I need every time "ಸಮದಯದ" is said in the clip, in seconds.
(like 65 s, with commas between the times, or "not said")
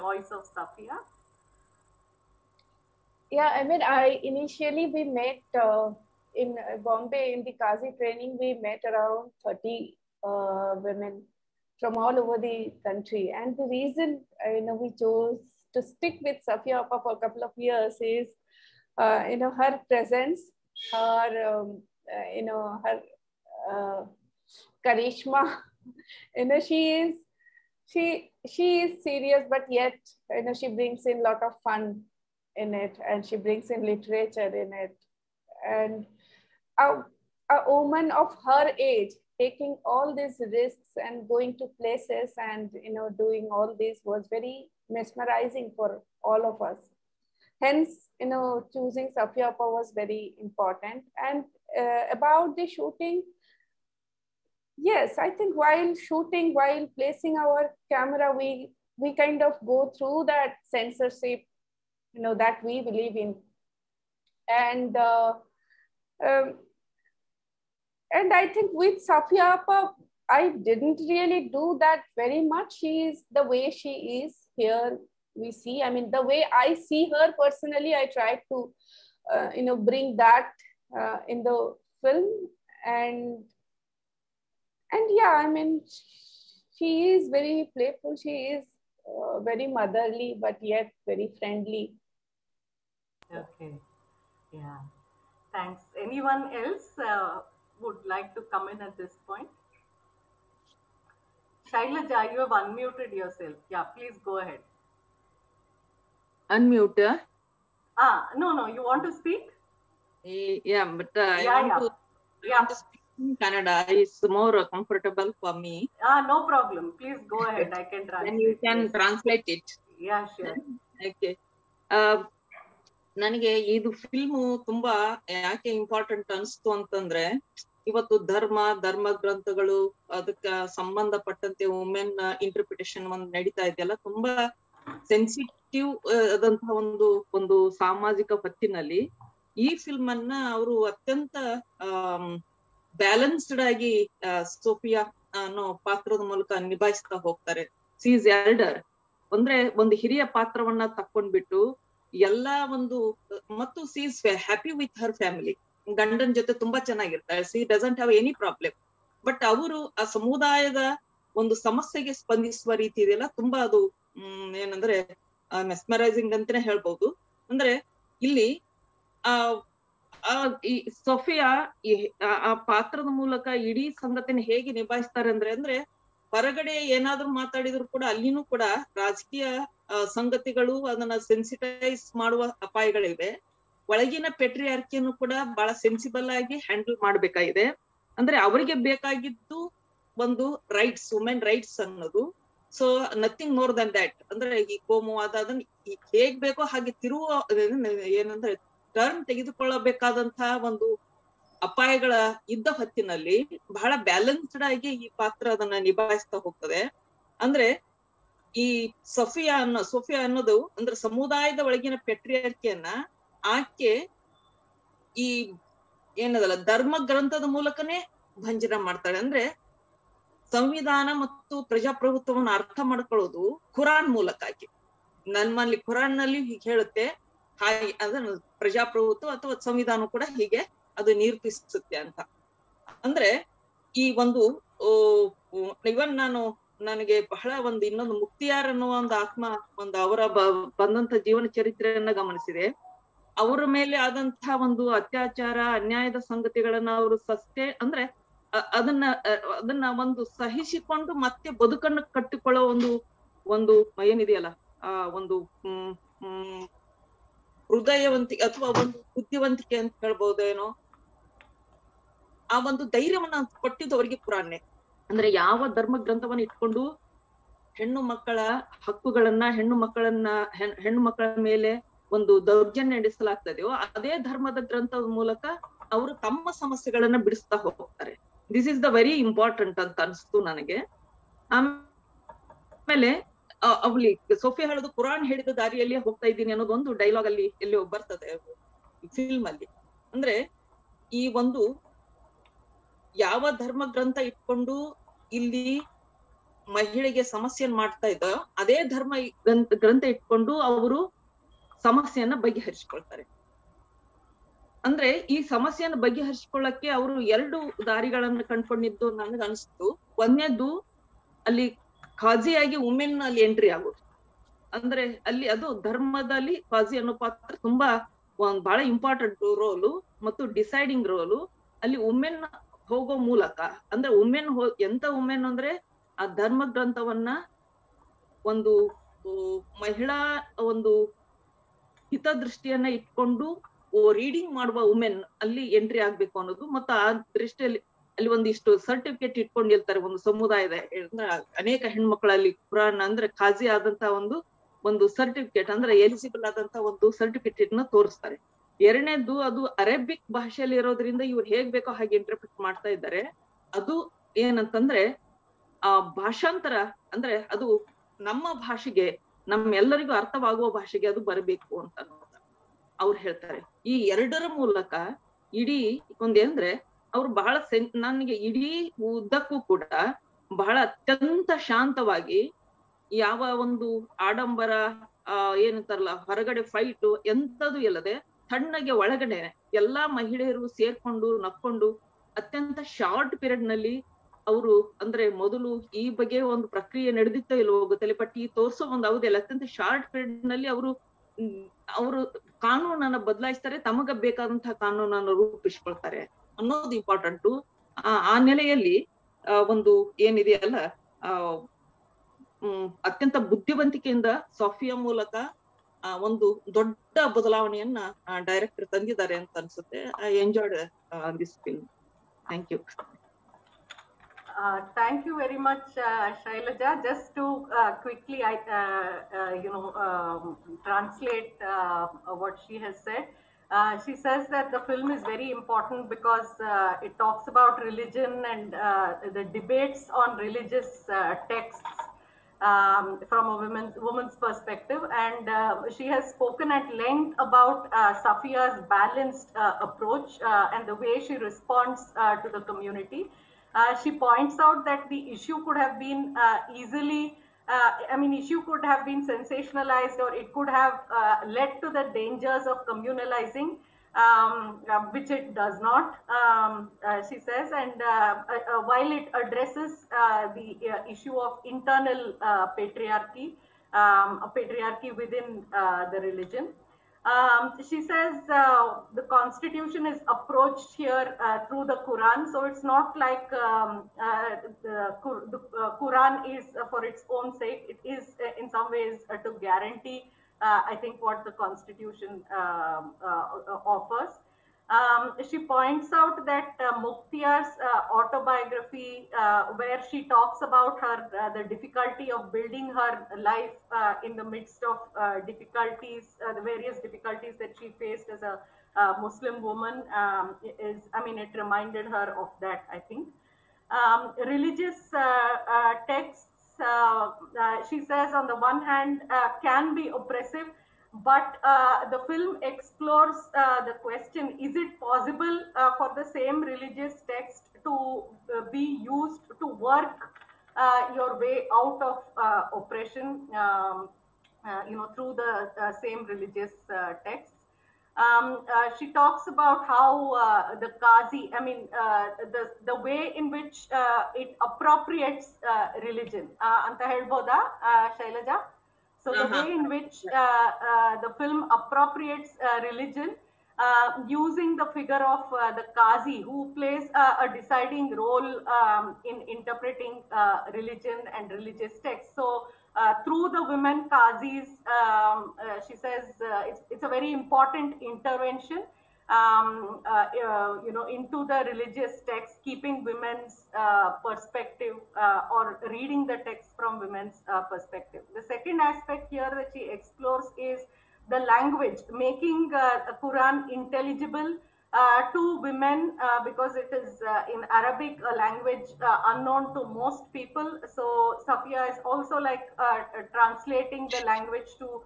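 160 s, 211 s, 340 s.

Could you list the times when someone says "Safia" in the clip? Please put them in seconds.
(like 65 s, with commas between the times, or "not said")
0 s, 16 s, 49 s, 69 s, 438 s, 581 s.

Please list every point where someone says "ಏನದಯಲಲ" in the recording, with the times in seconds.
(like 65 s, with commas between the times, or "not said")
254 s, 400 s.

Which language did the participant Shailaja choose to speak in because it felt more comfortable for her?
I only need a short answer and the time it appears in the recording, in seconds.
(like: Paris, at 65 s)
Kannada, at 113 s.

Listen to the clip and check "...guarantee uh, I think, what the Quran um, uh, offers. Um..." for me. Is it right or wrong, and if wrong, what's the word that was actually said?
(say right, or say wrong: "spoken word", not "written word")
wrong: "Constitution", not "Quran".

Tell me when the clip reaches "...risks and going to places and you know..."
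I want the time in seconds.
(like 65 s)
40 s.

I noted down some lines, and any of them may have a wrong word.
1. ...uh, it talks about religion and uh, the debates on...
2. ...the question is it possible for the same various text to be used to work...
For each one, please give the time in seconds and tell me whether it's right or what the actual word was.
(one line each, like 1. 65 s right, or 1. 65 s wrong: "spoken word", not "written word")
1. 426 s right
2. 513 s wrong: "religious", not "various".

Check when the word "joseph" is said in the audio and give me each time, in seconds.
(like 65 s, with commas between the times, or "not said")
not said.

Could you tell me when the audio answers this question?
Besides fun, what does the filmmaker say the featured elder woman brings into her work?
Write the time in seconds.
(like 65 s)
33 s.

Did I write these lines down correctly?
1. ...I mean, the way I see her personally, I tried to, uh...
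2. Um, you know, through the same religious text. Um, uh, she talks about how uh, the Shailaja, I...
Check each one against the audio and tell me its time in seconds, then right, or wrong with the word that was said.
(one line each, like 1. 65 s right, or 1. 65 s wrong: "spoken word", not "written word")
1. 75 s right
2. 523 s wrong: "Qazi", not "Shailaja".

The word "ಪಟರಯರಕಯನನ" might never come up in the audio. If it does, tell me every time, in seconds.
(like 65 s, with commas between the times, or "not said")
184 s, 212 s.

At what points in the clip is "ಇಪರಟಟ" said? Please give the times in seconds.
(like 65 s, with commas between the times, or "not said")
125 s, 279 s, 318 s, 396 s.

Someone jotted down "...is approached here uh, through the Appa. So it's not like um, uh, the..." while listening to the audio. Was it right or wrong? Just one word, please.
wrong.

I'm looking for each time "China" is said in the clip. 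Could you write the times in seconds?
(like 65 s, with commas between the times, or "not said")
not said.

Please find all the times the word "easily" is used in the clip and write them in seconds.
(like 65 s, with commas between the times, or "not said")
446 s.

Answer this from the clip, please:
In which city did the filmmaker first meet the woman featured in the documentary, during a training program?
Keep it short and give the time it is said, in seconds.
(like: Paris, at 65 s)
Bombay, at 6 s.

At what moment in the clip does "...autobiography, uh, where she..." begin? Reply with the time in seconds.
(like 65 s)
488 s.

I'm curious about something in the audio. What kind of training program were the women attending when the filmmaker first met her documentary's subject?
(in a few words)
Qazi training.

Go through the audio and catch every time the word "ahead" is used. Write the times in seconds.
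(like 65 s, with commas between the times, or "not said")
104 s, 117 s.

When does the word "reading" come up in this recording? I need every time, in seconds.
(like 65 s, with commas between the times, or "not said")
565 s.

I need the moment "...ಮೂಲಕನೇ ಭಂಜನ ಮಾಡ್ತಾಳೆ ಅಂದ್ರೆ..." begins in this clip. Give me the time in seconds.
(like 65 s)
217 s.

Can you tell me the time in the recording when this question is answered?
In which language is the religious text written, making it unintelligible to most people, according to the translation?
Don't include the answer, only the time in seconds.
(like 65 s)
577 s.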